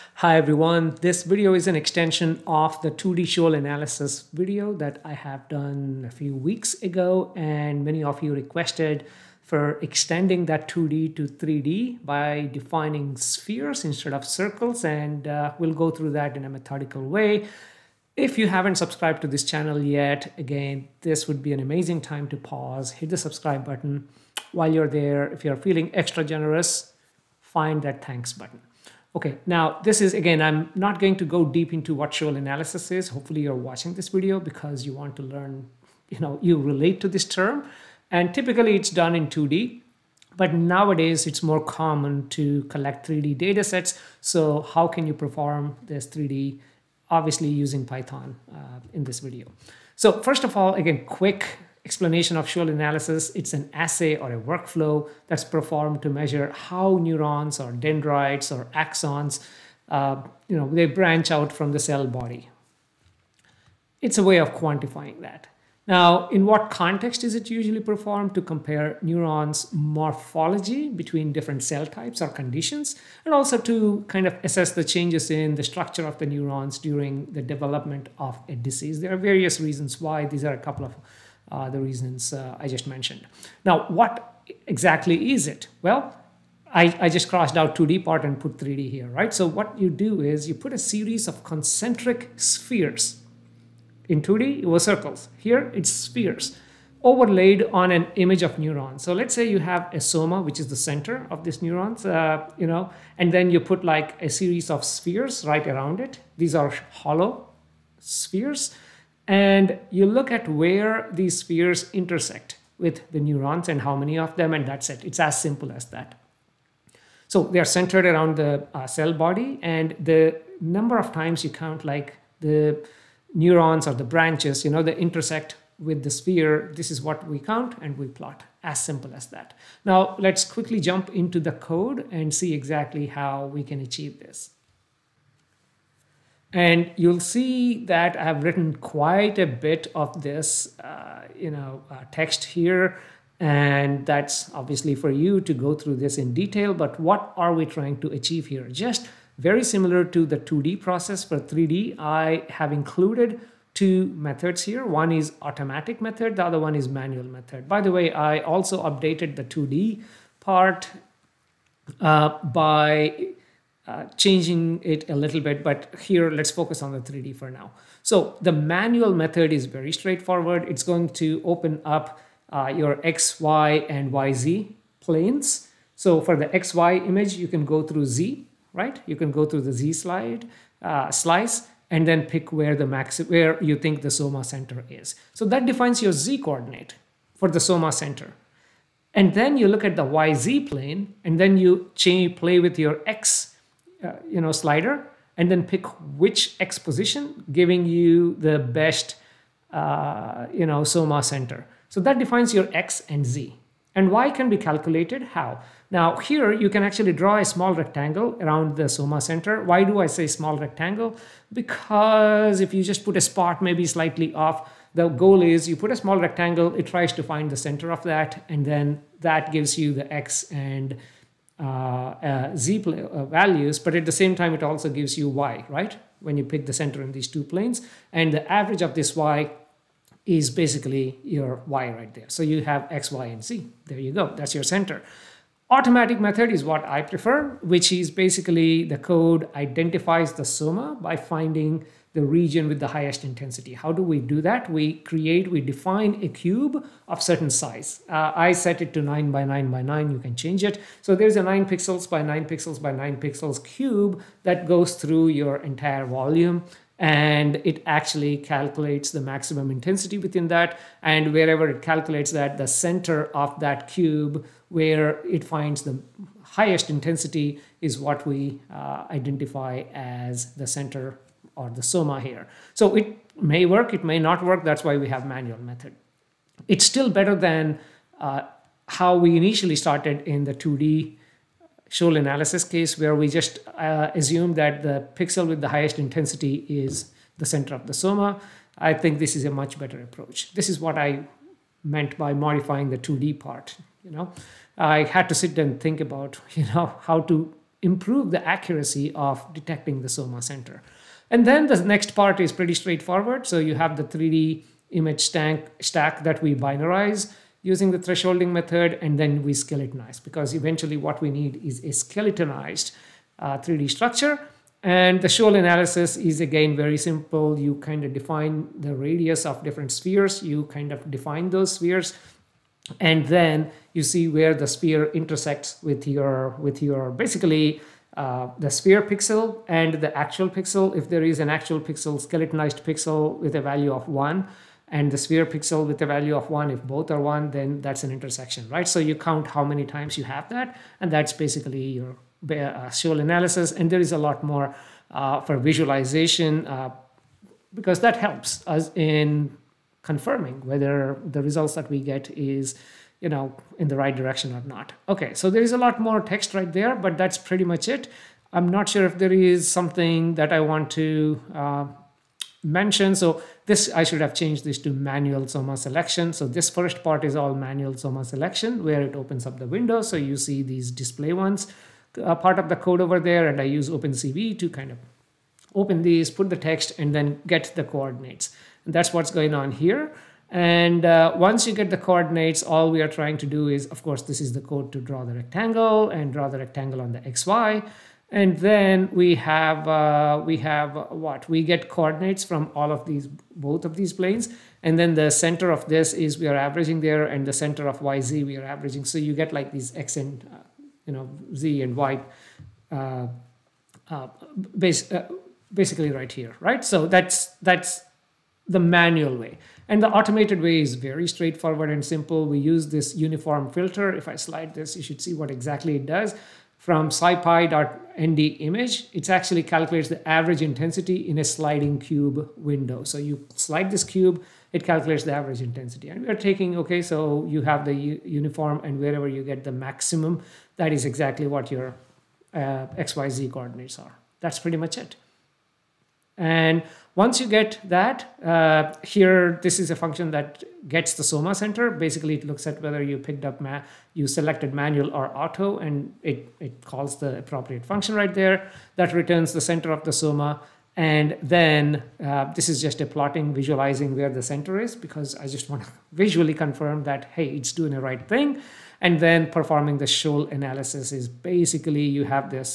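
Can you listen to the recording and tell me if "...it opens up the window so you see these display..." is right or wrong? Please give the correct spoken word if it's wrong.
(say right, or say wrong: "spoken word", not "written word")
right.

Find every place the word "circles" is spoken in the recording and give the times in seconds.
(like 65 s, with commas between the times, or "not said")
14 s, 94 s.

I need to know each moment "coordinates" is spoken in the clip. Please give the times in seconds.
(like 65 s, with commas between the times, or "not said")
186 s, 377 s, 381 s, 391 s, 433 s.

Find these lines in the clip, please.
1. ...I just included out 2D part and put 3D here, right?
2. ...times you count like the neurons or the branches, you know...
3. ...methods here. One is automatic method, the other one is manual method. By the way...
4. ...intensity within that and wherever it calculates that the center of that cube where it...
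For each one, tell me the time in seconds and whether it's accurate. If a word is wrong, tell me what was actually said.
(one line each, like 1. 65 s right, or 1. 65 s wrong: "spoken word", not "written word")
1. 87 s wrong: "crossed", not "included"
2. 121 s right
3. 154 s right
4. 259 s right.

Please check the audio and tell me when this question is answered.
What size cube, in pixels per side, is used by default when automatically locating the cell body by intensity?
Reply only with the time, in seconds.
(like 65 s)
249 s.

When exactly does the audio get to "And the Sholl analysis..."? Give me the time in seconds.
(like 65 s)
314 s.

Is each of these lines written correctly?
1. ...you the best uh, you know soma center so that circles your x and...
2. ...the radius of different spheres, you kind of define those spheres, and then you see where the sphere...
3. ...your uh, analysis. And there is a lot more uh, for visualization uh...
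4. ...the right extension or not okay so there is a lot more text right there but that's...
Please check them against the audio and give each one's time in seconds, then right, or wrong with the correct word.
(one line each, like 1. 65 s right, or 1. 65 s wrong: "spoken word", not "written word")
1. 197 s wrong: "defines", not "circles"
2. 318 s right
3. 341 s right
4. 353 s wrong: "direction", not "extension".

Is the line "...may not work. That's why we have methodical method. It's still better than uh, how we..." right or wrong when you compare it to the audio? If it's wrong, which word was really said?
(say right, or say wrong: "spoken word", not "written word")
wrong: "manual", not "methodical".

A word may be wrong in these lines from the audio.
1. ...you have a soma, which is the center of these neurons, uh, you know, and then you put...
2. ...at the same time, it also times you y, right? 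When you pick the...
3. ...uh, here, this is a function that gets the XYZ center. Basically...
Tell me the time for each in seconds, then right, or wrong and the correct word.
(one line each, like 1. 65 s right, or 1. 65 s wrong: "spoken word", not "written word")
1. 99 s right
2. 223 s wrong: "gives", not "times"
3. 438 s wrong: "Soma", not "XYZ".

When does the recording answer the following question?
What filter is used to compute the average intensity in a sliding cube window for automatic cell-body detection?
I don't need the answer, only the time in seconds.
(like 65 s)
413 s.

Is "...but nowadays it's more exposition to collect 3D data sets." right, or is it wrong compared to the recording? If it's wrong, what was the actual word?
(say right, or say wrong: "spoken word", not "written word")
wrong: "common", not "exposition".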